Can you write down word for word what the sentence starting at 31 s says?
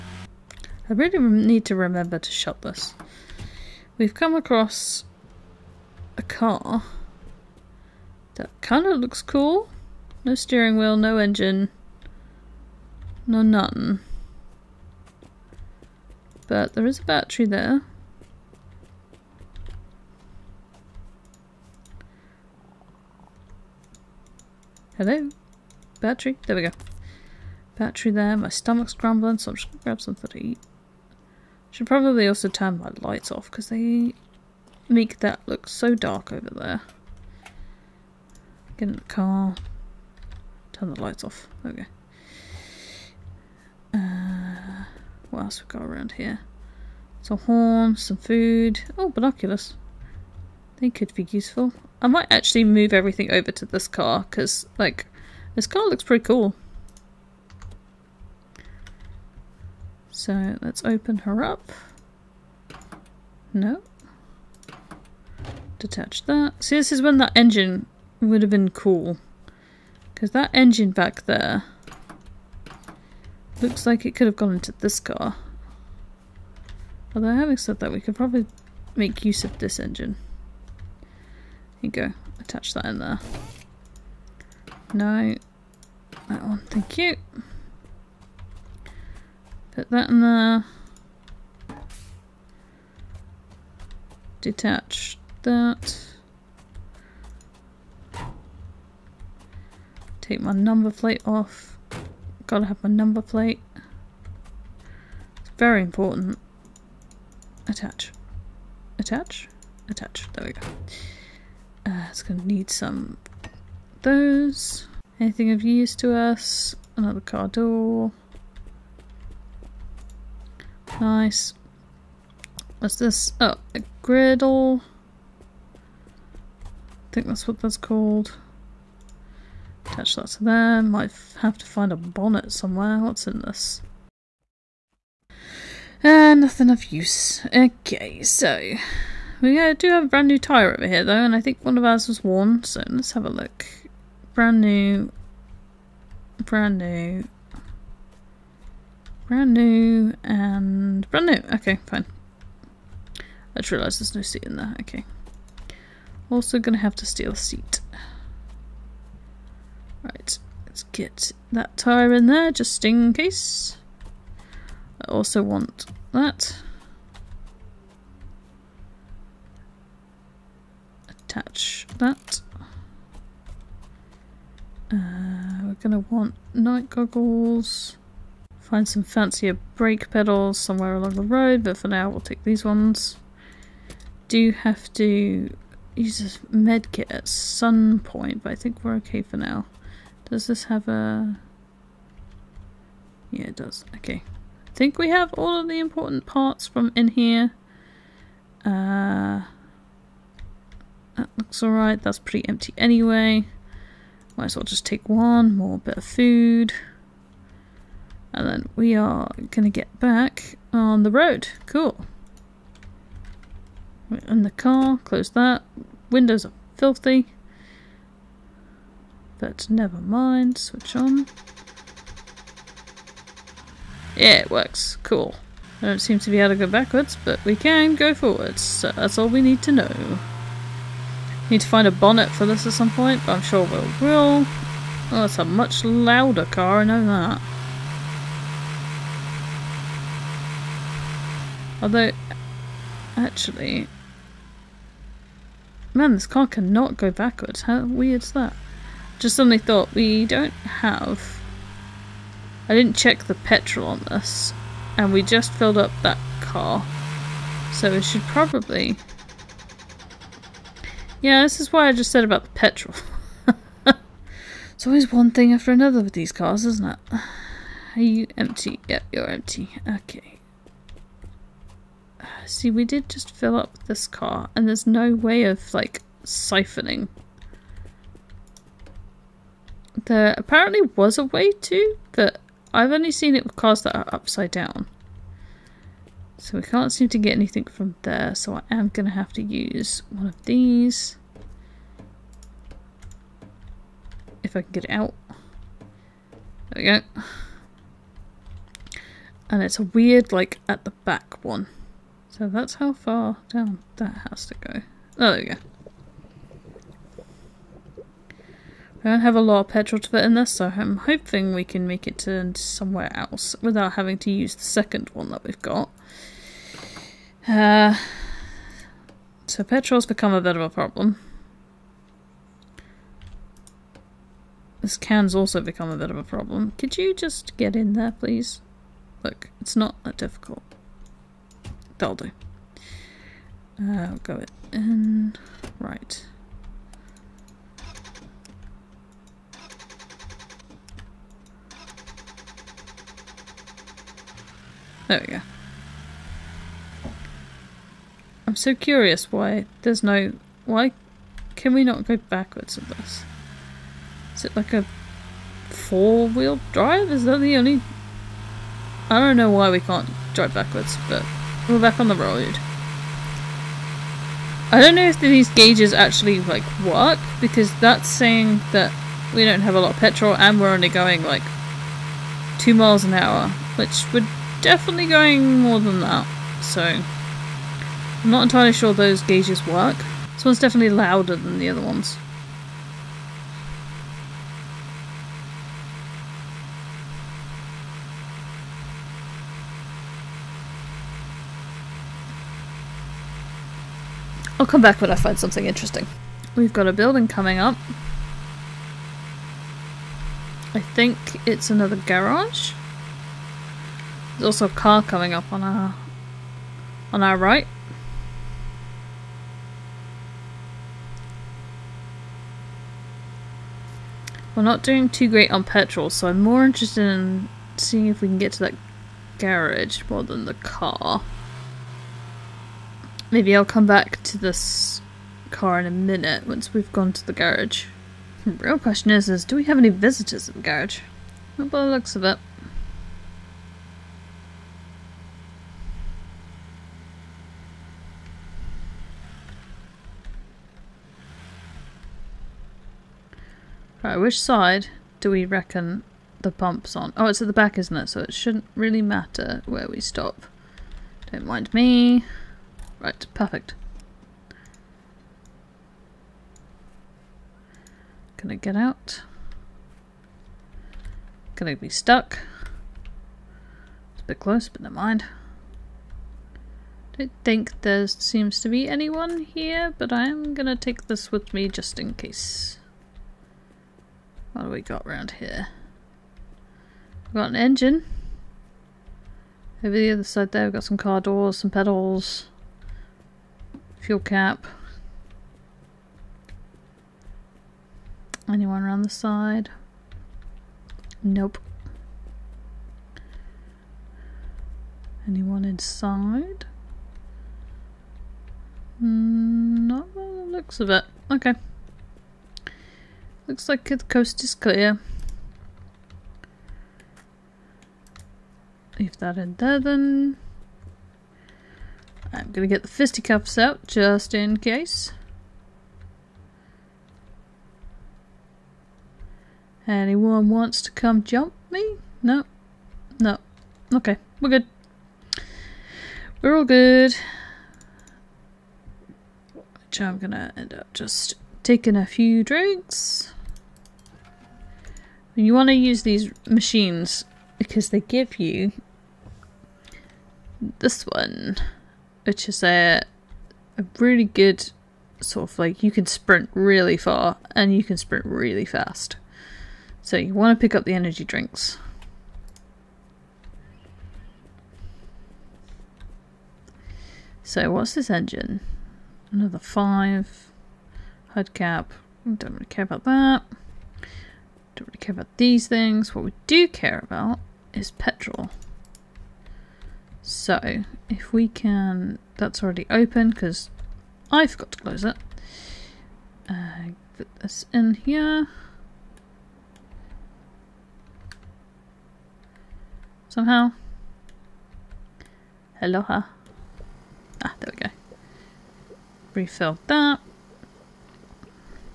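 Should probably also turn my lights off because they make that look so dark over there.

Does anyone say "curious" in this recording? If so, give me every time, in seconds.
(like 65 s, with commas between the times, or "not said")
348 s.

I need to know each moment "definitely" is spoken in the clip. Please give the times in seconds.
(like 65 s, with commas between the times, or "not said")
374 s, 380 s.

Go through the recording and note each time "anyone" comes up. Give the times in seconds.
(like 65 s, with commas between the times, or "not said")
468 s, 488 s, 495 s, 519 s.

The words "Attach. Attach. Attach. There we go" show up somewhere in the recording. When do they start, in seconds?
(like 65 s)
107 s.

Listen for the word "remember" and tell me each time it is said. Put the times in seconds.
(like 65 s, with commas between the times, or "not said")
1 s.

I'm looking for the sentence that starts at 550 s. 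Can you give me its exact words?
So you want to pick up the energy drinks.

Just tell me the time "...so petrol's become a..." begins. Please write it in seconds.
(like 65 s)
319 s.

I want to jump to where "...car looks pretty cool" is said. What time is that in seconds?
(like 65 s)
55 s.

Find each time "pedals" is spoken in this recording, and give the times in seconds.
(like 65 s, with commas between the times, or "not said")
180 s, 481 s.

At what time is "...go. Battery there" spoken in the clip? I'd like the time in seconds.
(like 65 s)
26 s.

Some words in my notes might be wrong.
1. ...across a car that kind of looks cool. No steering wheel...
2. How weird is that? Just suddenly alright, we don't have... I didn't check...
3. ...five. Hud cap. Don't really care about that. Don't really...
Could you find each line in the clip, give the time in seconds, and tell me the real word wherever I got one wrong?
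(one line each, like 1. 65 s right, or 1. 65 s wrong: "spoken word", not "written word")
1. 4 s right
2. 247 s wrong: "thought", not "alright"
3. 559 s right.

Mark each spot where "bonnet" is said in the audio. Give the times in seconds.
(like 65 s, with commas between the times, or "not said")
131 s, 231 s.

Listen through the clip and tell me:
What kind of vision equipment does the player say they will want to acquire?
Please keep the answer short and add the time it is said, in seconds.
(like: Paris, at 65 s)
Night goggles, at 176 s.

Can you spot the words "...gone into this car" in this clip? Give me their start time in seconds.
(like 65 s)
74 s.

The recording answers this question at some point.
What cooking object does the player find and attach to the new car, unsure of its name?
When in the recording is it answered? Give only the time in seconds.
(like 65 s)
123 s.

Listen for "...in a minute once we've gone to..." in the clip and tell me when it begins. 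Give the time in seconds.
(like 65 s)
425 s.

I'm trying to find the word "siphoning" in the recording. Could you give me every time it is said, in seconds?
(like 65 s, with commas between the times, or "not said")
276 s.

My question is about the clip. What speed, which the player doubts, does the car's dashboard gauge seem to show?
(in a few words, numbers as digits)
2 miles an hour.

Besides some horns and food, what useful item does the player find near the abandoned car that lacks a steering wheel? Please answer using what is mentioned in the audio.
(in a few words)
Binoculars.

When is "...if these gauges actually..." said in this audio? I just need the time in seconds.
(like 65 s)
365 s.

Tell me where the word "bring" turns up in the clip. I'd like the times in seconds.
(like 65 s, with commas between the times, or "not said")
not said.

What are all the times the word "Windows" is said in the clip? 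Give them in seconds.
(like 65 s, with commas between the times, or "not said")
216 s.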